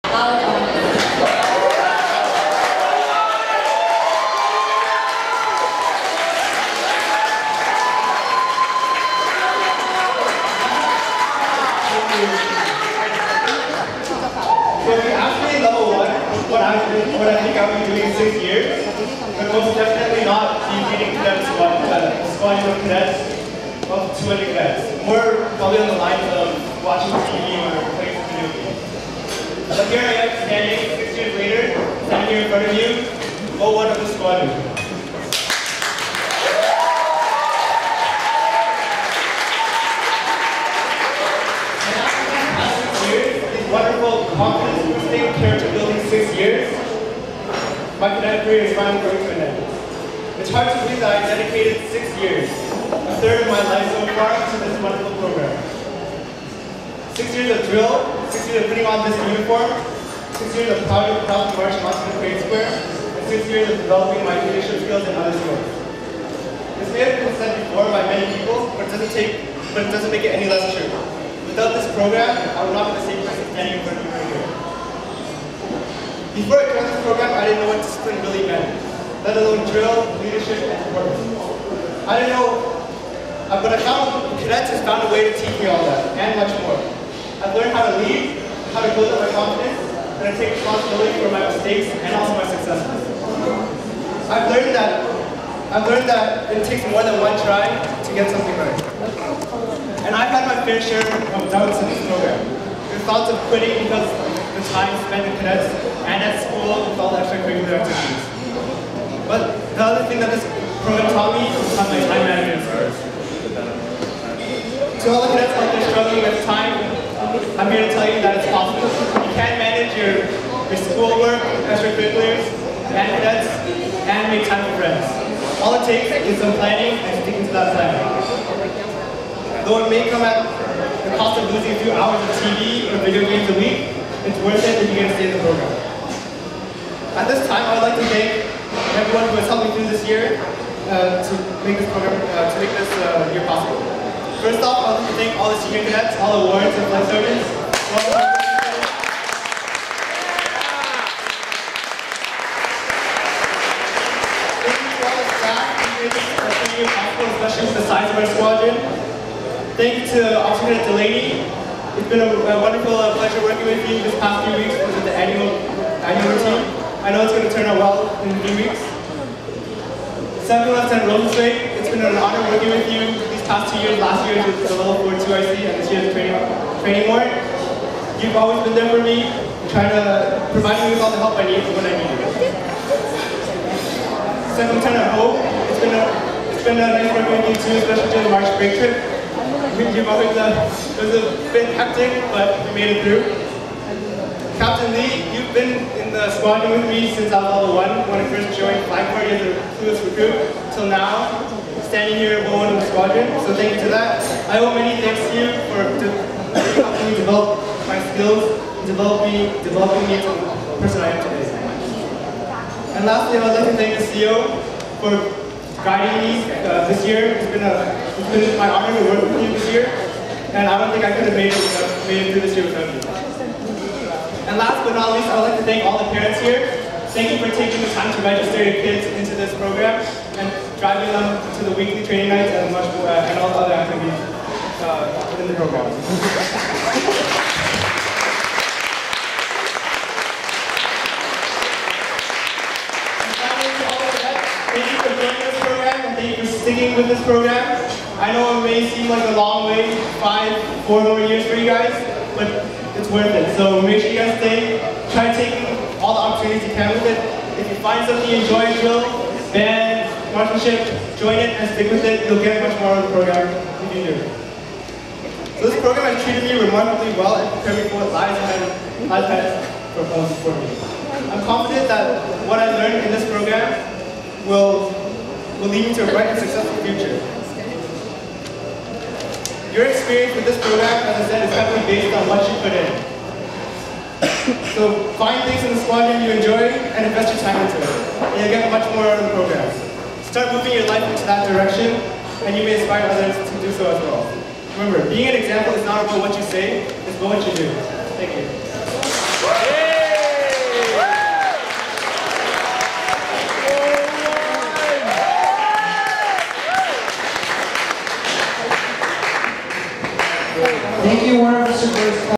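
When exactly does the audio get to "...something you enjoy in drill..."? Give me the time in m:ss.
4:18.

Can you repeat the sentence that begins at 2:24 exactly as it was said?
First off, I would like to thank all the senior cadets, all awards, and flight sergeants.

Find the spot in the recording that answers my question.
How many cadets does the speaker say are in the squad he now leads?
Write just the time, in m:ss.
0:24.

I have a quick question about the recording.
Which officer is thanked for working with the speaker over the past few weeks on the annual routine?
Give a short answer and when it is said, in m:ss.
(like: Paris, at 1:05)
Officer Delaney, at 2:40.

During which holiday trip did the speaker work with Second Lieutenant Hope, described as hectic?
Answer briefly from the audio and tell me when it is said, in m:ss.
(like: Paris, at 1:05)
March break, at 3:08.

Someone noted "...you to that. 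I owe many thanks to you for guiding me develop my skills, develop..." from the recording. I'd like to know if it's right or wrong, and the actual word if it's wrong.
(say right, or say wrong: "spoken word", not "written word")
wrong: "helping", not "guiding".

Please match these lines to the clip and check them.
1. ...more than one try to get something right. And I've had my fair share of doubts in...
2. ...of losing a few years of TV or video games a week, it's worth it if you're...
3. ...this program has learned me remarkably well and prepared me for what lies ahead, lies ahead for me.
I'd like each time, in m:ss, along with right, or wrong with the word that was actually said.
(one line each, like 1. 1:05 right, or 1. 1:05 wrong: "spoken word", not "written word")
1. 1:36 right
2. 2:11 wrong: "hours", not "years"
3. 4:25 wrong: "treated", not "learned".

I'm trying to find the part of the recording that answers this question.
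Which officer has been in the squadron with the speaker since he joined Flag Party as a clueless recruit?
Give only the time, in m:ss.
3:14.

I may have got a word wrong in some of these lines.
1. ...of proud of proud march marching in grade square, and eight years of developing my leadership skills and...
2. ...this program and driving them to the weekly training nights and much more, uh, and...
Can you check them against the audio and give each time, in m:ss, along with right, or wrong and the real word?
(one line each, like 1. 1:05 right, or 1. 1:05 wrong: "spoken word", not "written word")
1. 1:00 wrong: "six", not "eight"
2. 3:49 right.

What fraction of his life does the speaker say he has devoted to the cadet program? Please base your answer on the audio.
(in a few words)
a third.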